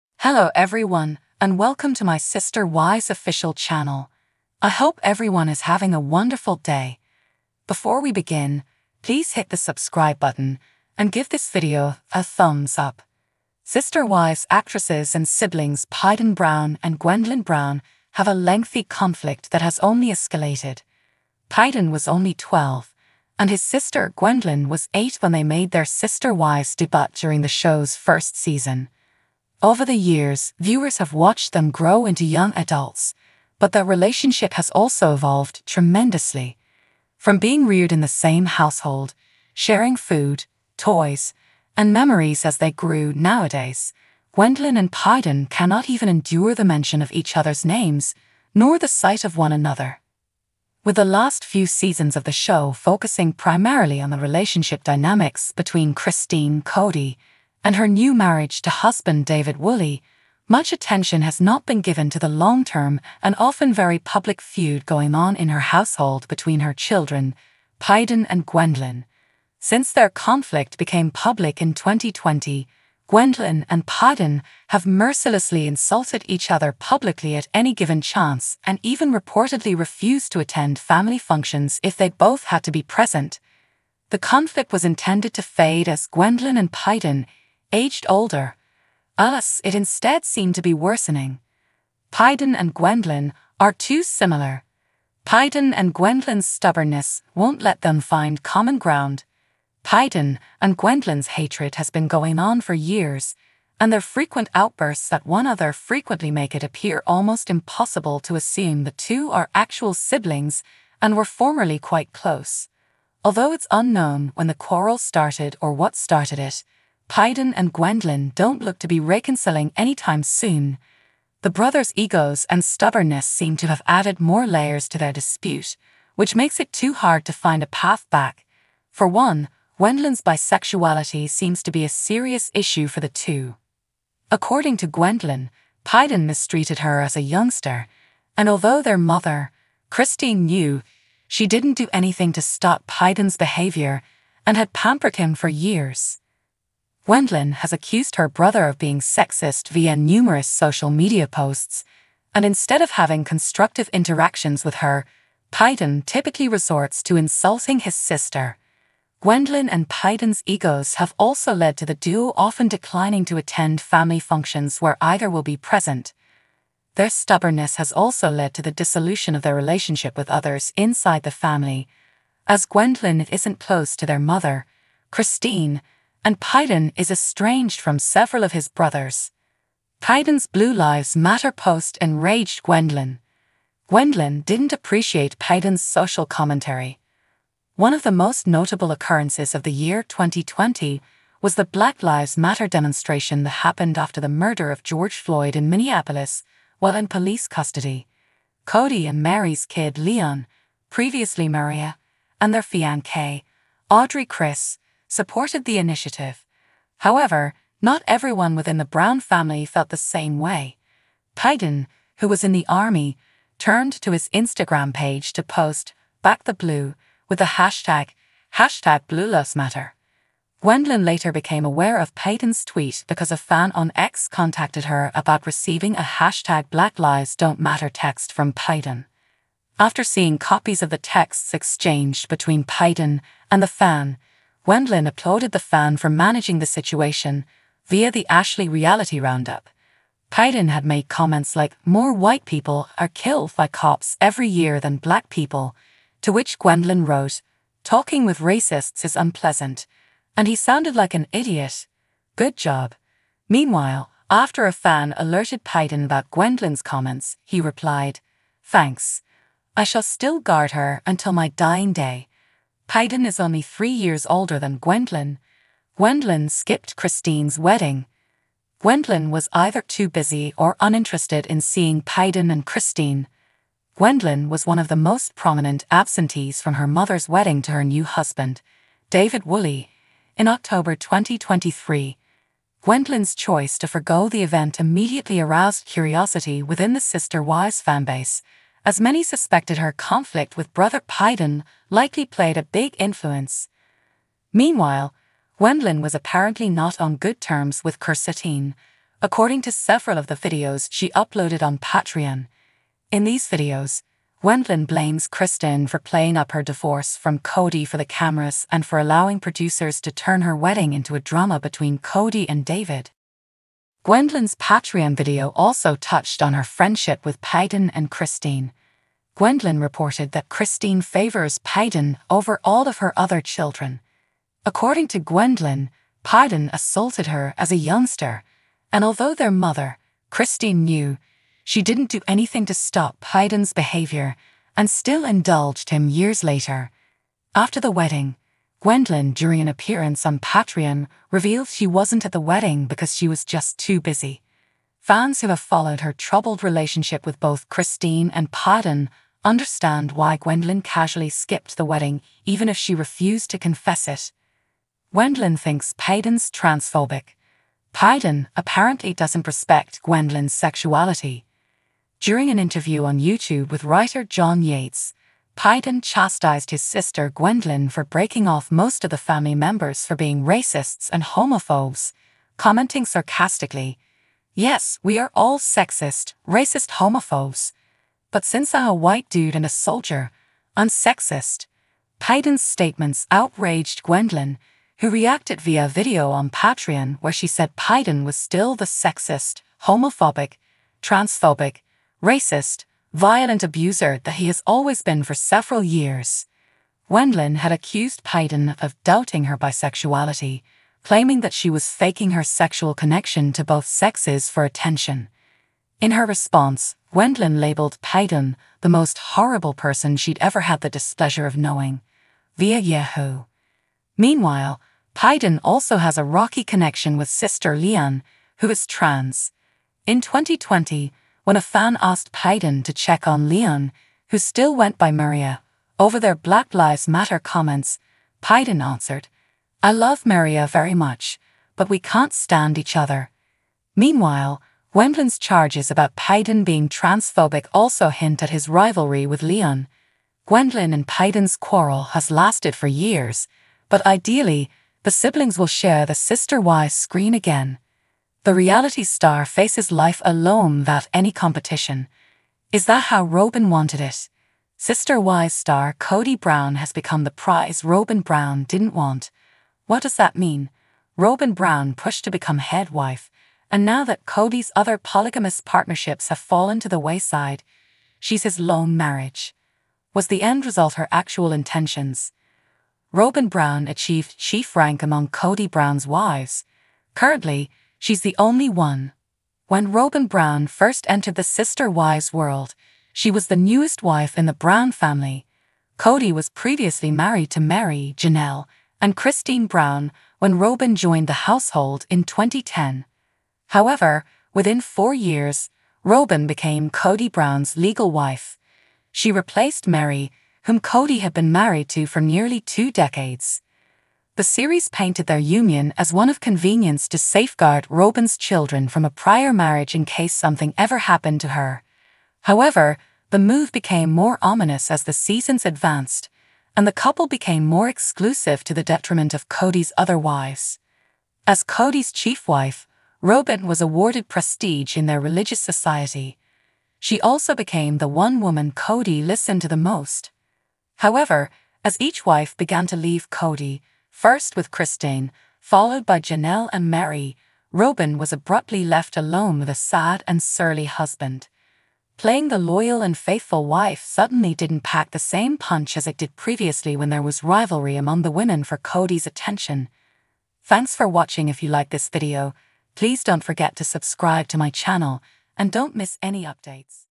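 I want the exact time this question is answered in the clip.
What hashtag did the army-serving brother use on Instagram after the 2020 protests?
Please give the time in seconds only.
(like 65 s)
219 s.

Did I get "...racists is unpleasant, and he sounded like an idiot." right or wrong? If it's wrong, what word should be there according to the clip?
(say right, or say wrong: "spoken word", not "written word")
right.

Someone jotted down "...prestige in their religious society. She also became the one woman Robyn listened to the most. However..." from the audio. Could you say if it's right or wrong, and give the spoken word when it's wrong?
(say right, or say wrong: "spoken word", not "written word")
wrong: "Kody", not "Robyn".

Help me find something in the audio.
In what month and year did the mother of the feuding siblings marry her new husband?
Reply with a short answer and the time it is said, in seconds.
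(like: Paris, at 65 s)
October 2023, at 280 s.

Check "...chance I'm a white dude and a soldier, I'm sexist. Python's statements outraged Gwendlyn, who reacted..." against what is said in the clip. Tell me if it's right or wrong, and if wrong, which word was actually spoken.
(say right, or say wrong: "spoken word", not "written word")
wrong: "since", not "chance".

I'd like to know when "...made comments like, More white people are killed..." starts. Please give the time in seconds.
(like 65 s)
240 s.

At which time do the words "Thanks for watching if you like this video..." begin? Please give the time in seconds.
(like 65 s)
550 s.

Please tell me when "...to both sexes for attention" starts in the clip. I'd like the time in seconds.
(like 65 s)
403 s.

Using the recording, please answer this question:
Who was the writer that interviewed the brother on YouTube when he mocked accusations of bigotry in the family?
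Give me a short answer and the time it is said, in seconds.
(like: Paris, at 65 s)
John Yates, at 364 s.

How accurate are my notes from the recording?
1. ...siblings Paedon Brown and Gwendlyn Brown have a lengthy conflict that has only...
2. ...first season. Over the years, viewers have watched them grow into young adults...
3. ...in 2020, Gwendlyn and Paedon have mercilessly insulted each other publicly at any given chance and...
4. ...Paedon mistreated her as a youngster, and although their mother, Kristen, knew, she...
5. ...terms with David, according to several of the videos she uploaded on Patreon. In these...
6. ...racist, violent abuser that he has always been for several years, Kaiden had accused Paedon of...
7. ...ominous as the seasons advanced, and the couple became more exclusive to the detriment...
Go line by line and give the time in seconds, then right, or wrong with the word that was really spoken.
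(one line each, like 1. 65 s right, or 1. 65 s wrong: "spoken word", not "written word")
1. 15 s right
2. 27 s right
3. 71 s right
4. 135 s wrong: "Christine", not "Kristen"
5. 297 s wrong: "Kirsten", not "David"
6. 392 s wrong: "Wendlin", not "Kaiden"
7. 514 s right.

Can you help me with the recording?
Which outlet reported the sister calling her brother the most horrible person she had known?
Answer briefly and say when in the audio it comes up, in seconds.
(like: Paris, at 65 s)
Yahoo, at 412 s.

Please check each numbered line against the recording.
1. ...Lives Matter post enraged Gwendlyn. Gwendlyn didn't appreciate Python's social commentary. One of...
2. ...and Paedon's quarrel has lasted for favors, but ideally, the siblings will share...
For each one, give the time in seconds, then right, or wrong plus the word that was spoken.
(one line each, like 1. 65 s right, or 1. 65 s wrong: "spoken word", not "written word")
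1. 180 s right
2. 440 s wrong: "years", not "favors".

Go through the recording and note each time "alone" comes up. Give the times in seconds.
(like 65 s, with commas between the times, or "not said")
450 s, 539 s.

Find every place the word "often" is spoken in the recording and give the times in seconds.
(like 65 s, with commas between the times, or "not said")
63 s, 162 s.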